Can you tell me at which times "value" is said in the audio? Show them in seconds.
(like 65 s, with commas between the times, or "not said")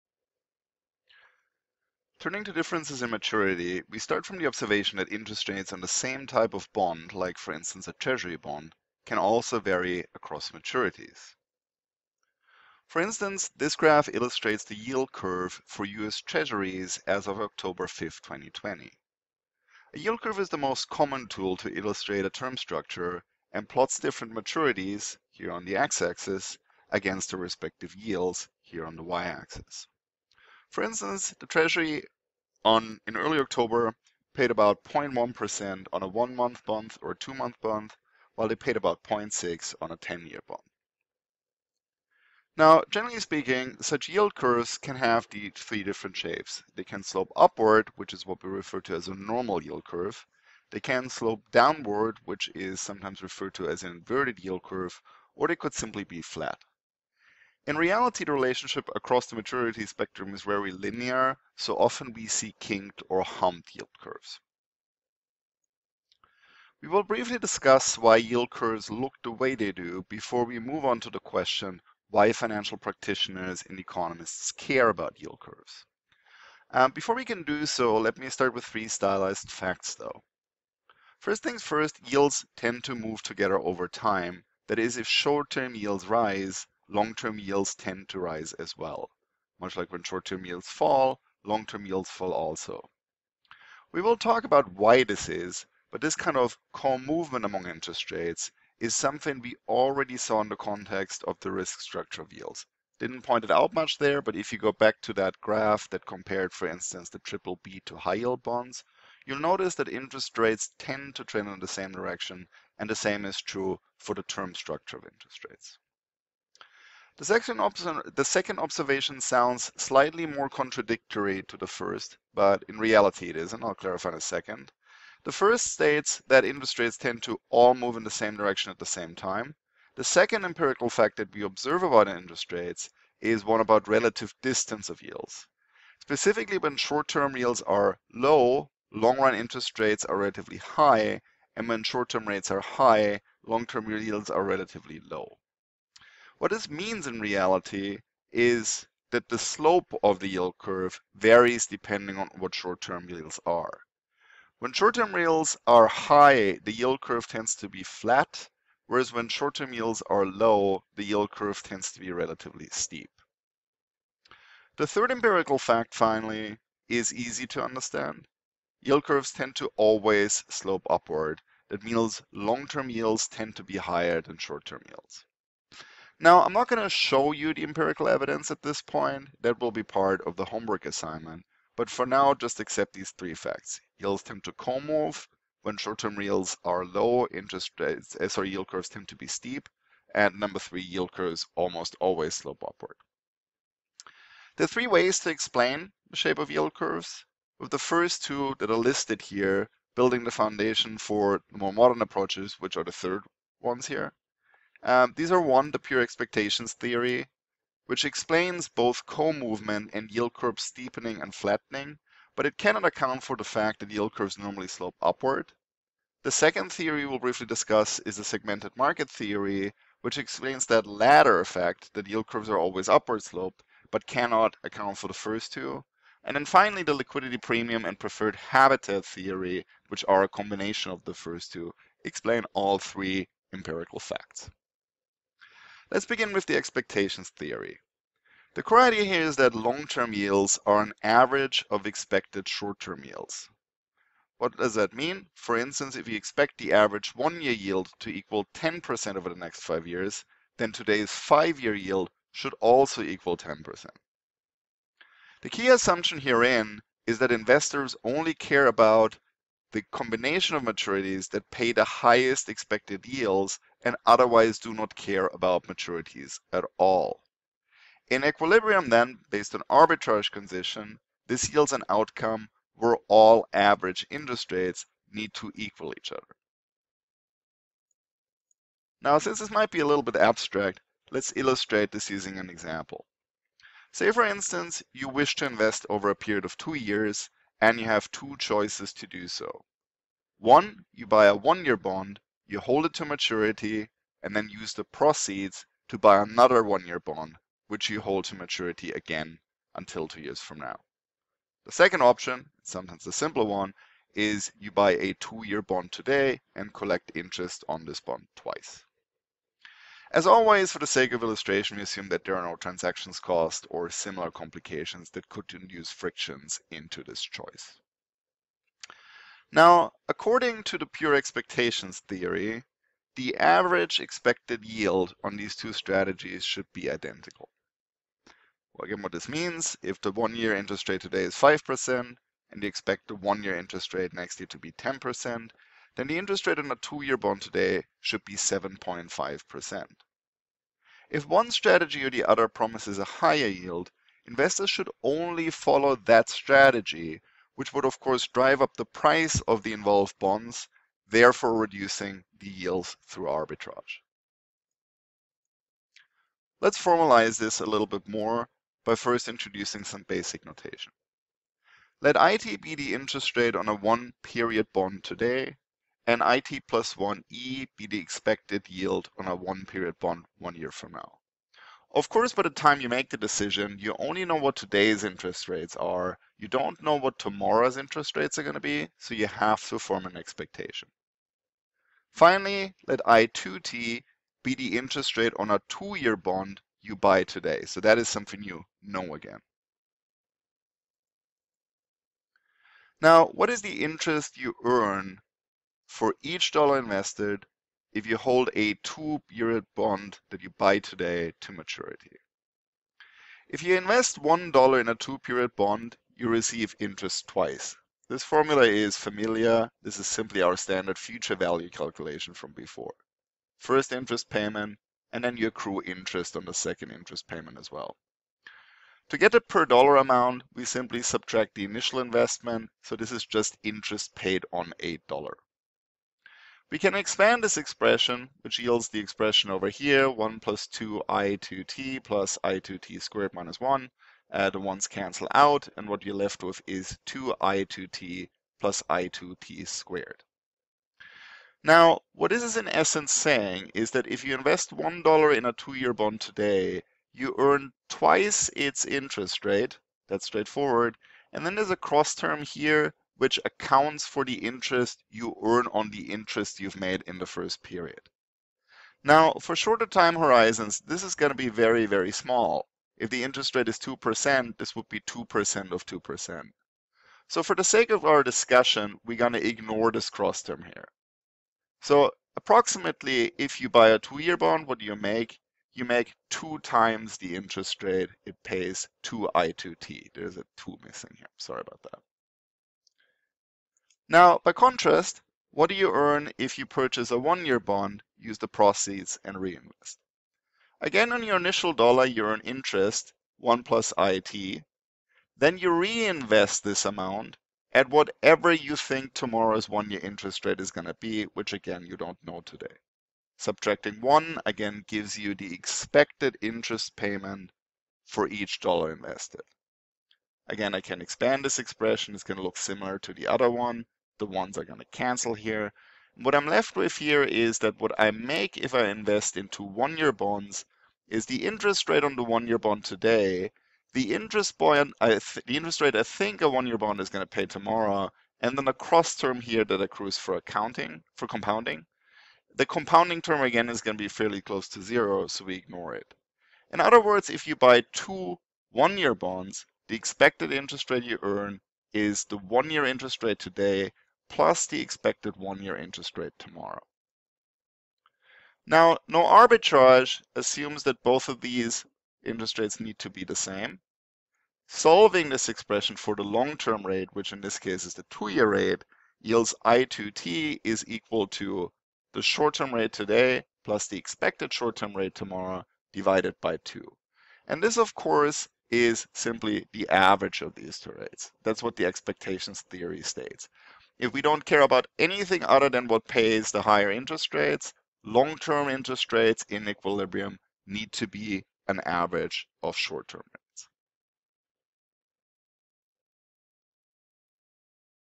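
411 s.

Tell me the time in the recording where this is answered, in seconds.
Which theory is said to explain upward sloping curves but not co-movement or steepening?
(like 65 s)
218 s.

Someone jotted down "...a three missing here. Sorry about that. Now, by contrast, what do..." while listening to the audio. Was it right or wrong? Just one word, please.
wrong.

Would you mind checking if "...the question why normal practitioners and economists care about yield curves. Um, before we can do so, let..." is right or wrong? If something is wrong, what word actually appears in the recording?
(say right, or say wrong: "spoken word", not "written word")
wrong: "financial", not "normal".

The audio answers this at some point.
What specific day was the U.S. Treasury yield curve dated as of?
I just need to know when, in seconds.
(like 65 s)
17 s.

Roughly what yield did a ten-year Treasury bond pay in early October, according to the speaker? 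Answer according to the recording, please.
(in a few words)
0.6%.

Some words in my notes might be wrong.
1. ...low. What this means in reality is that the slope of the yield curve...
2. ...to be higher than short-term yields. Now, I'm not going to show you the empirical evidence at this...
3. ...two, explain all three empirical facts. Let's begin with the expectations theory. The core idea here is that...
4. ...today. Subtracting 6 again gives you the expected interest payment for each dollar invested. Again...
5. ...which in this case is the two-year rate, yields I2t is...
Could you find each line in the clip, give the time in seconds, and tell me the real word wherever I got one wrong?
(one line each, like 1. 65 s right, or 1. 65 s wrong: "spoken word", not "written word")
1. 145 s right
2. 173 s right
3. 231 s right
4. 502 s wrong: "1", not "6"
5. 557 s right.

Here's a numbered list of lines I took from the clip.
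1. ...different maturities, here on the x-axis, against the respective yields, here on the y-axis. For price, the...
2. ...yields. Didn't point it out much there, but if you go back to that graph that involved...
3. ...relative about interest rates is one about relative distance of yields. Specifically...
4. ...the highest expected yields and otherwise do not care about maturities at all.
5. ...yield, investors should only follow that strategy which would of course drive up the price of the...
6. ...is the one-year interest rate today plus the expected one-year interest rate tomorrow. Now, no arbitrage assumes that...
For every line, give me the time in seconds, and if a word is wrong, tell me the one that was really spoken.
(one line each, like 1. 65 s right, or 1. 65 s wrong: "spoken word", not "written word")
1. 23 s wrong: "instance", not "price"
2. 102 s wrong: "compared", not "involved"
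3. 131 s wrong: "observe", not "relative"
4. 261 s right
5. 343 s right
6. 541 s right.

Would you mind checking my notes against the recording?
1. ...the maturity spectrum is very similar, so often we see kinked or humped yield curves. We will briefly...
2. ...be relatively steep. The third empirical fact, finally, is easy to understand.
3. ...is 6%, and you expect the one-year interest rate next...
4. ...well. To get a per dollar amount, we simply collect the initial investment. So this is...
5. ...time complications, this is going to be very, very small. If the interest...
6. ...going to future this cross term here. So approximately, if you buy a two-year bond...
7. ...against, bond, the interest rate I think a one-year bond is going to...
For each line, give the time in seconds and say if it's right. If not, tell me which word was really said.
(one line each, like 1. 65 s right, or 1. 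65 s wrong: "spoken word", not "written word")
1. 59 s wrong: "linear", not "similar"
2. 161 s right
3. 331 s wrong: "5", not "6"
4. 417 s wrong: "subtract", not "collect"
5. 459 s wrong: "horizons", not "complications"
6. 469 s wrong: "ignore", not "future"
7. 524 s wrong: "interest", not "against".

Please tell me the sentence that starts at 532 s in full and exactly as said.
The compounding term again is going to be fairly close to zero, so we ignore it.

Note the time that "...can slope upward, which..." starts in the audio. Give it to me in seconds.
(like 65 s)
46 s.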